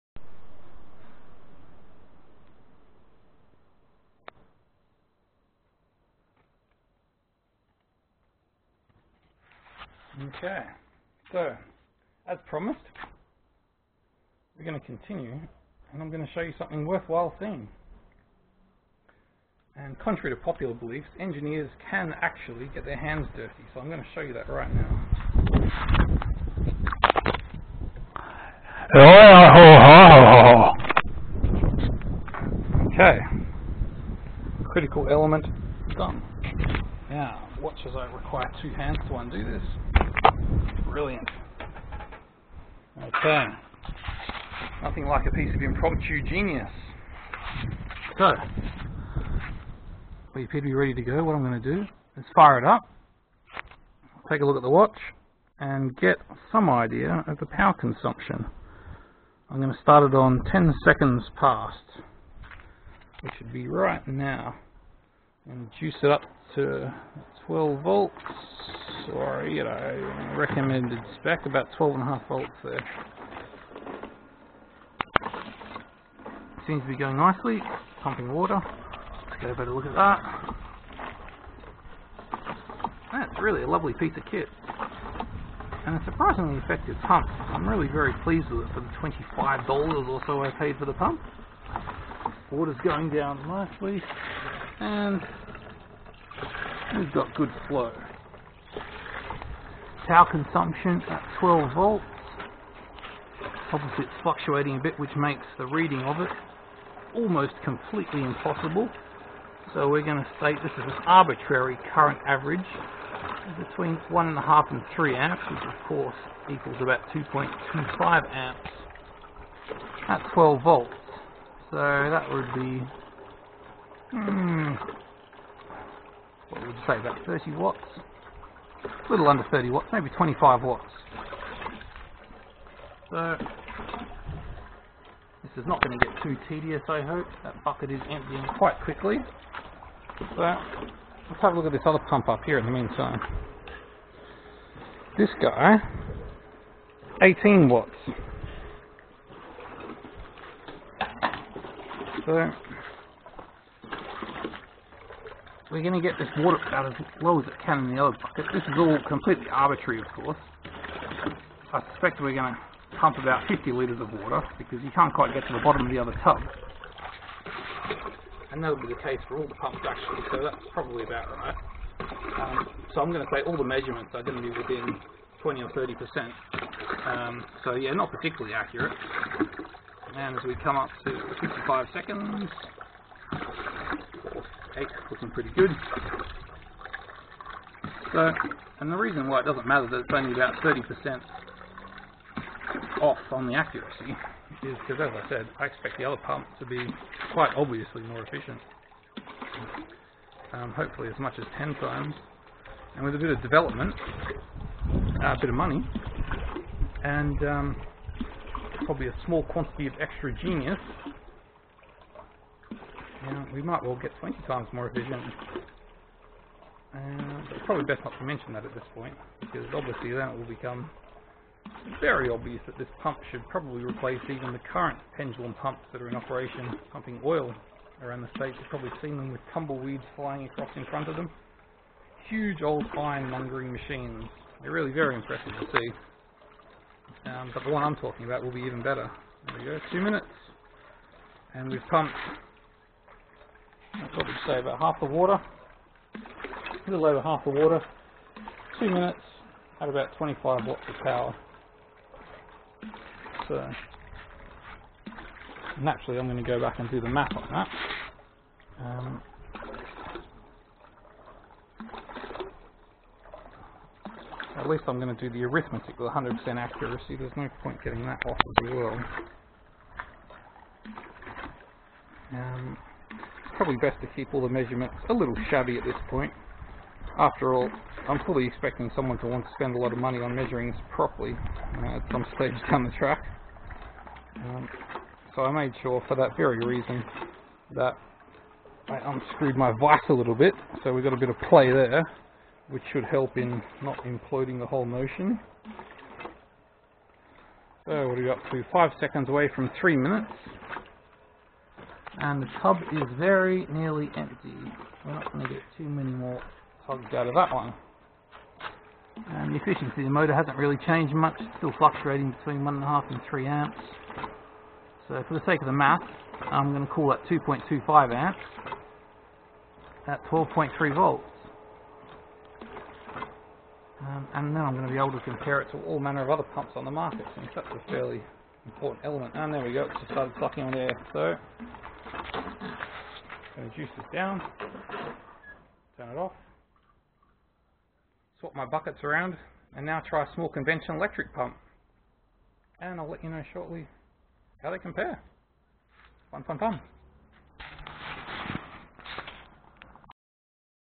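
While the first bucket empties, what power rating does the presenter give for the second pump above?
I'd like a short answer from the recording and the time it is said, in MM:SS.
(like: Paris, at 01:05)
18 watts, at 02:27.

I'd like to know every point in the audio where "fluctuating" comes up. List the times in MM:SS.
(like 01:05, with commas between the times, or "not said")
01:44, 05:11.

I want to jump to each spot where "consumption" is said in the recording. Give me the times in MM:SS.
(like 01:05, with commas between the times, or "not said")
00:57, 01:40.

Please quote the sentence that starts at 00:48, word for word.
So, we appear to be ready to go.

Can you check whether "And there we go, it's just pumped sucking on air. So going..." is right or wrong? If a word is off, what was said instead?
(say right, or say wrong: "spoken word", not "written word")
wrong: "started", not "pumped".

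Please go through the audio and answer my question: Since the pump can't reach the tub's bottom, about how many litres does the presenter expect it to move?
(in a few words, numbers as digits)
50 litres.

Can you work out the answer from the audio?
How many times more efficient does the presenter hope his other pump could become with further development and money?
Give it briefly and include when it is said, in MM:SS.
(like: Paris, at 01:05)
20 times, at 03:34.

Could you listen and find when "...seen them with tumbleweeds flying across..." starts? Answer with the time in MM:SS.
03:49.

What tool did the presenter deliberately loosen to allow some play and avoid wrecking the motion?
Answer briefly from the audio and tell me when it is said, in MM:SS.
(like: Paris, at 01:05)
vise, at 04:49.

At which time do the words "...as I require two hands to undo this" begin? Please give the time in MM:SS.
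00:37.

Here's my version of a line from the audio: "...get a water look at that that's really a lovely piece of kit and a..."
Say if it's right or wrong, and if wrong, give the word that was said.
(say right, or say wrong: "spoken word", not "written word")
wrong: "better", not "water".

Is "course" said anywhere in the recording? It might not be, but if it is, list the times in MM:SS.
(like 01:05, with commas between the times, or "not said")
01:55, 02:40.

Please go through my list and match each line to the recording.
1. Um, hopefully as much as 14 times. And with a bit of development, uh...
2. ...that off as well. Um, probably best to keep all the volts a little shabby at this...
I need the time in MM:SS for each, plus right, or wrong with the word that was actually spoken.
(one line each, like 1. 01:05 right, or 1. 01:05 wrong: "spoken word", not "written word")
1. 03:20 wrong: "10", not "14"
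2. 04:28 wrong: "measurements", not "volts".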